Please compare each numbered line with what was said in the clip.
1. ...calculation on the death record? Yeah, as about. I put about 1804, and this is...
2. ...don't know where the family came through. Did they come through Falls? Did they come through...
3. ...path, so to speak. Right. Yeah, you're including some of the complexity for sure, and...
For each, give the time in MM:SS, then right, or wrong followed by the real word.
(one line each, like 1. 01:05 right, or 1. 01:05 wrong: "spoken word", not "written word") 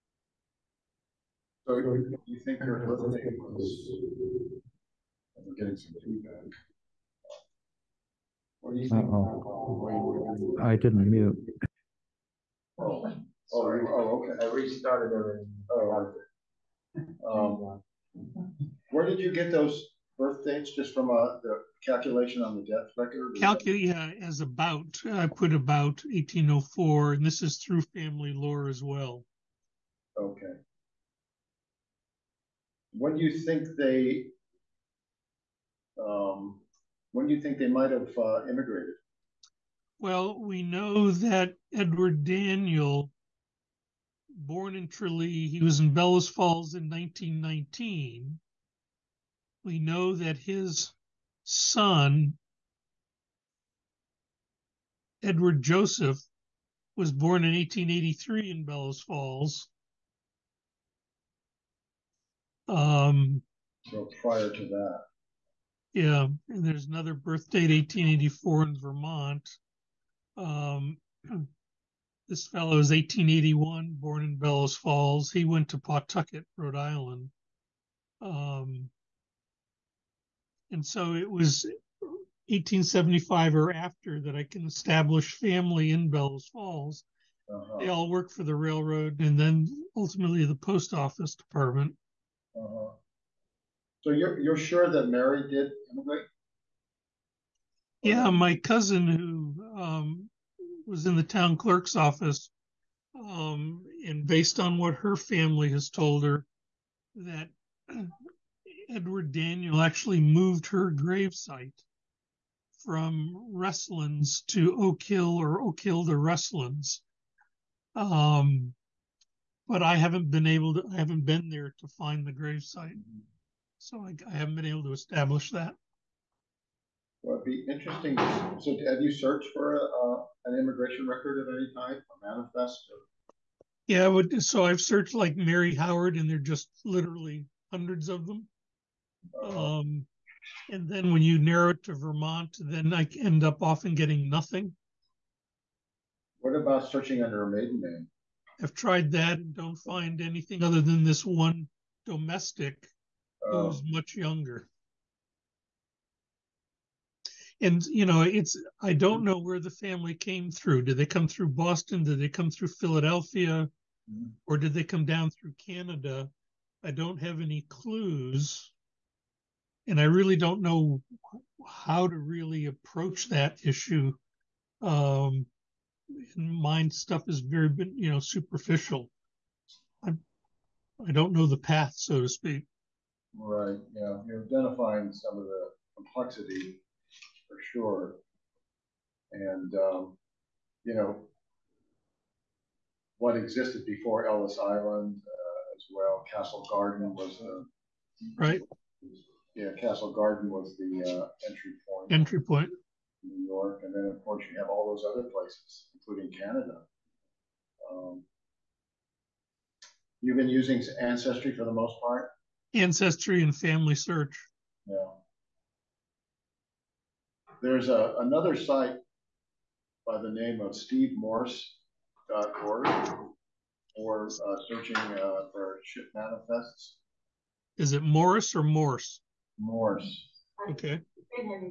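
1. 00:21 right
2. 02:38 wrong: "Boston", not "Falls"
3. 03:01 wrong: "identifying", not "including".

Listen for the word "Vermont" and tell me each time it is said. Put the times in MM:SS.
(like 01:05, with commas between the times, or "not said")
01:08, 02:21.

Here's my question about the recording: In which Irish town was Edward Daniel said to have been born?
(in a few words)
Tralee.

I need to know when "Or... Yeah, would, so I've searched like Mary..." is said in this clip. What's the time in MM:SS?
02:12.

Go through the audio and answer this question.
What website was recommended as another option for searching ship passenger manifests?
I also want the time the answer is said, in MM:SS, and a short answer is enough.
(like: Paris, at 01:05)
stevemorse.org, at 03:40.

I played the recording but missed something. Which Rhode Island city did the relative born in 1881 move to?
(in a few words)
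Pawtucket.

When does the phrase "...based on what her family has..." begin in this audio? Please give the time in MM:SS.
01:44.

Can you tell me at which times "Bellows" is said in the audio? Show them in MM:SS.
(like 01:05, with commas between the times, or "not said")
00:45, 00:58, 01:14, 01:26.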